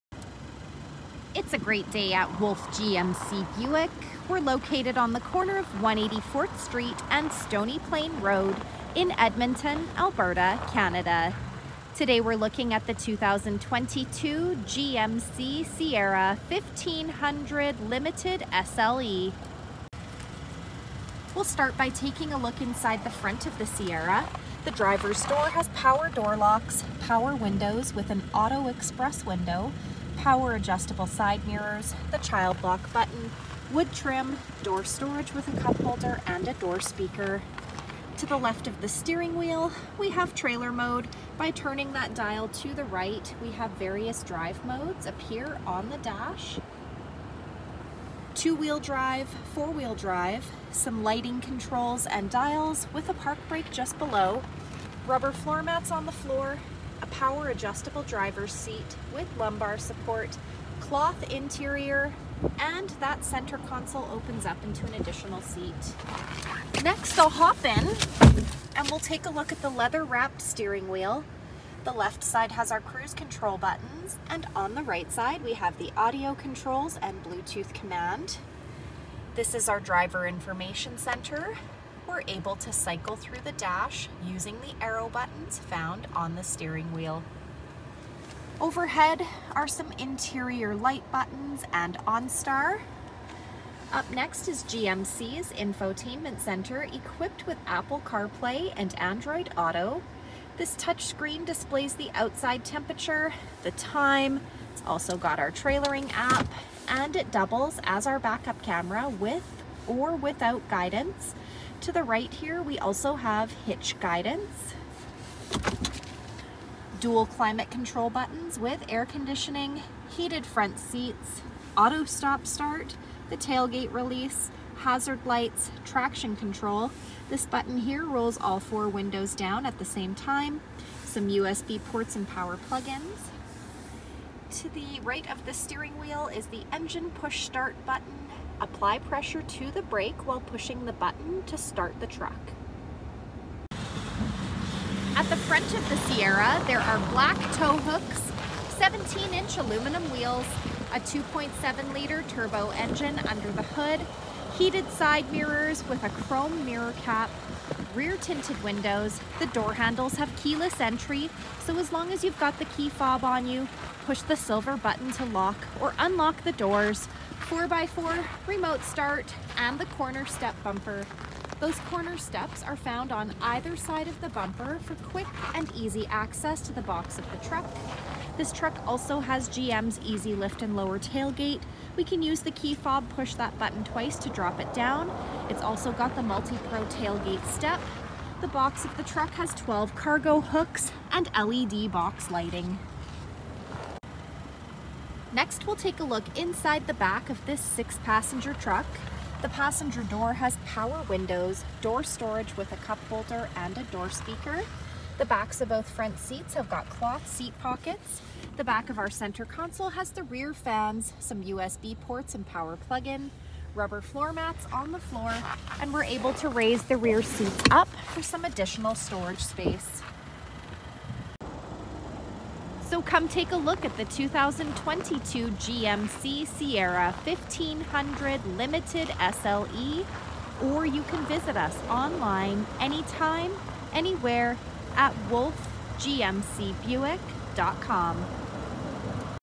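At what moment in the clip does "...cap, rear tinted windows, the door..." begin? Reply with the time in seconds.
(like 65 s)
157 s.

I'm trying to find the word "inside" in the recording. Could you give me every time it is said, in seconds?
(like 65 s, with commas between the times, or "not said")
22 s, 196 s.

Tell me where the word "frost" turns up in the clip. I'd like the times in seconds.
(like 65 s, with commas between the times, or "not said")
not said.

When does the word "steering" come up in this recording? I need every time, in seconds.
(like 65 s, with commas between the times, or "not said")
38 s, 70 s, 86 s, 135 s.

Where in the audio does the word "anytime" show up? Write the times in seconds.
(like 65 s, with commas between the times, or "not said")
232 s.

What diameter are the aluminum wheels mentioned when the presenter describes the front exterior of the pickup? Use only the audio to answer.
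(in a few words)
17-inch.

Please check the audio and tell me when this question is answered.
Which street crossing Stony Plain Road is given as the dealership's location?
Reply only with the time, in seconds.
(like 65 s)
5 s.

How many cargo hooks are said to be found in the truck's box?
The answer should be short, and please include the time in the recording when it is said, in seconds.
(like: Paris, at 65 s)
12, at 189 s.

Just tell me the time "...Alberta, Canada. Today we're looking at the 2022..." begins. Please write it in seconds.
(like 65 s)
9 s.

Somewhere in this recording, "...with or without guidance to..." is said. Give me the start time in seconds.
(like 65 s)
109 s.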